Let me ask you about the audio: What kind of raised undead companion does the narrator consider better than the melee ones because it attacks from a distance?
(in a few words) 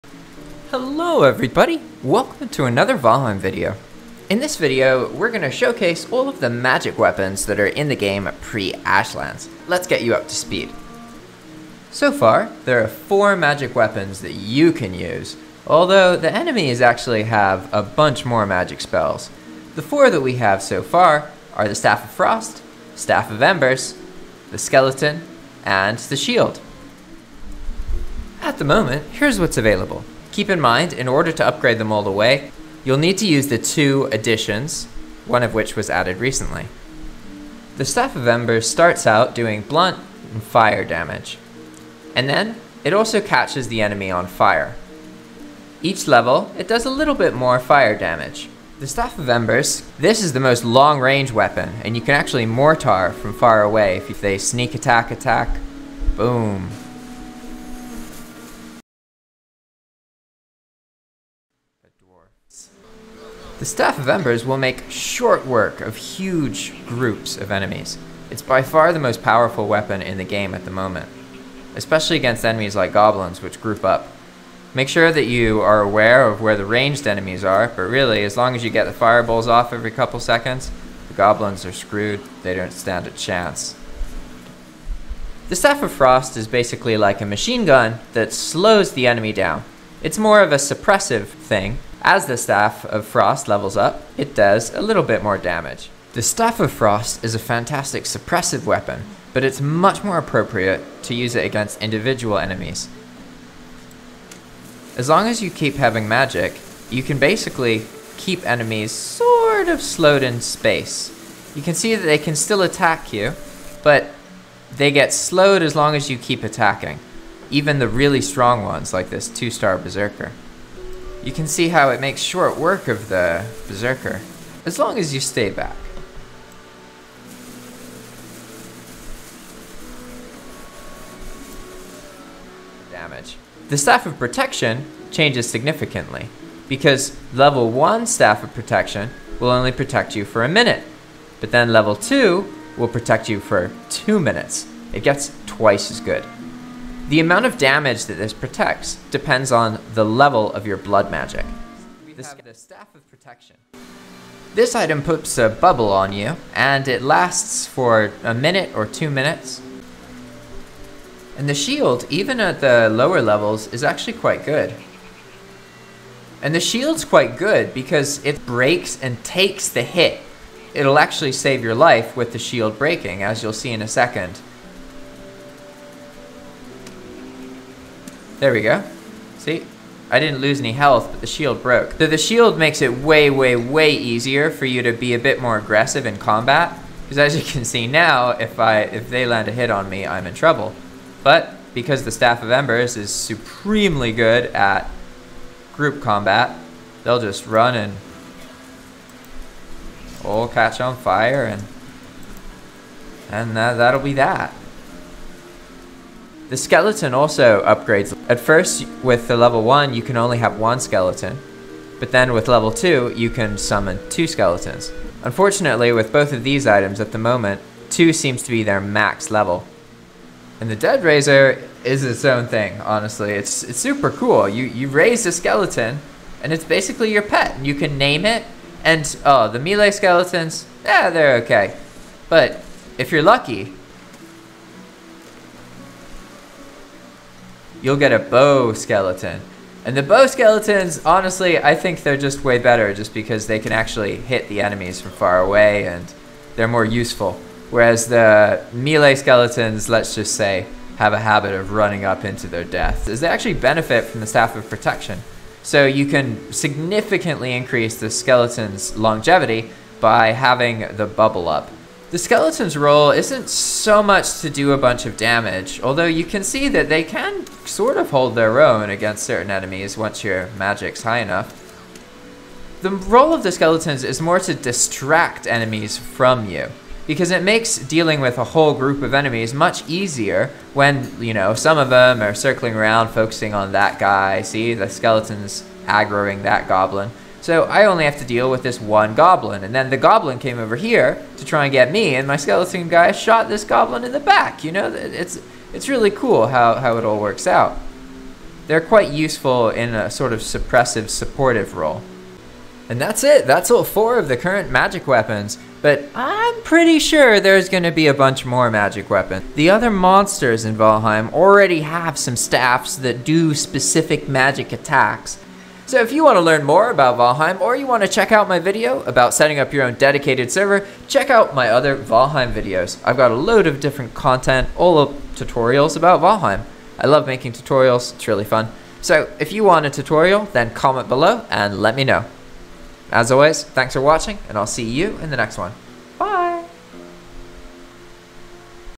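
Bow skeleton.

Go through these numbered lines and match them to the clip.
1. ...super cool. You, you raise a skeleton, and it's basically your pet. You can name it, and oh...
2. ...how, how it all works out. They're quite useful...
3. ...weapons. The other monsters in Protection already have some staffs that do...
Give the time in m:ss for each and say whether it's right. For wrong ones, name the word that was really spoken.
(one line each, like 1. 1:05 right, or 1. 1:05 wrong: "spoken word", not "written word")
1. 3:43 right
2. 4:56 right
3. 5:09 wrong: "Valheim", not "Protection".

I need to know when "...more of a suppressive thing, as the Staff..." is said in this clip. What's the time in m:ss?
1:30.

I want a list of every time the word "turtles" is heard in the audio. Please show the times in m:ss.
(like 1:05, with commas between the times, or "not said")
not said.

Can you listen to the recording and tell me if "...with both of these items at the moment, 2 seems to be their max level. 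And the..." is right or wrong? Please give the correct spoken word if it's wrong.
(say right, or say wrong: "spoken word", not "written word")
right.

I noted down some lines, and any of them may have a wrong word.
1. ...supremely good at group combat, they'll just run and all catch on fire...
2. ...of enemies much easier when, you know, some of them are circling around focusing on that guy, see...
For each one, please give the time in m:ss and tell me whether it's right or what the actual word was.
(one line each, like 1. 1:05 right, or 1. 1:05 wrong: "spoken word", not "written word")
1. 3:13 right
2. 4:39 right.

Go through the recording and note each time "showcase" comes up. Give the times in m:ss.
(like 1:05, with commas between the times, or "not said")
0:05.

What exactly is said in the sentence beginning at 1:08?
It's by far the most powerful weapon in the game at the moment, especially against enemies like goblins, which group up.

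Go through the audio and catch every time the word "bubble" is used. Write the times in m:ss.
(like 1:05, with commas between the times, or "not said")
2:35, 4:21.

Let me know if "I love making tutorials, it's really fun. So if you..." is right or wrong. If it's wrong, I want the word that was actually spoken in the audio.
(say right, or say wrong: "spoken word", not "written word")
right.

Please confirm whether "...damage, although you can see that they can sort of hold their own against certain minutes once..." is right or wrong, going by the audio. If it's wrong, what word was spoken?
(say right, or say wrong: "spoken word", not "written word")
wrong: "enemies", not "minutes".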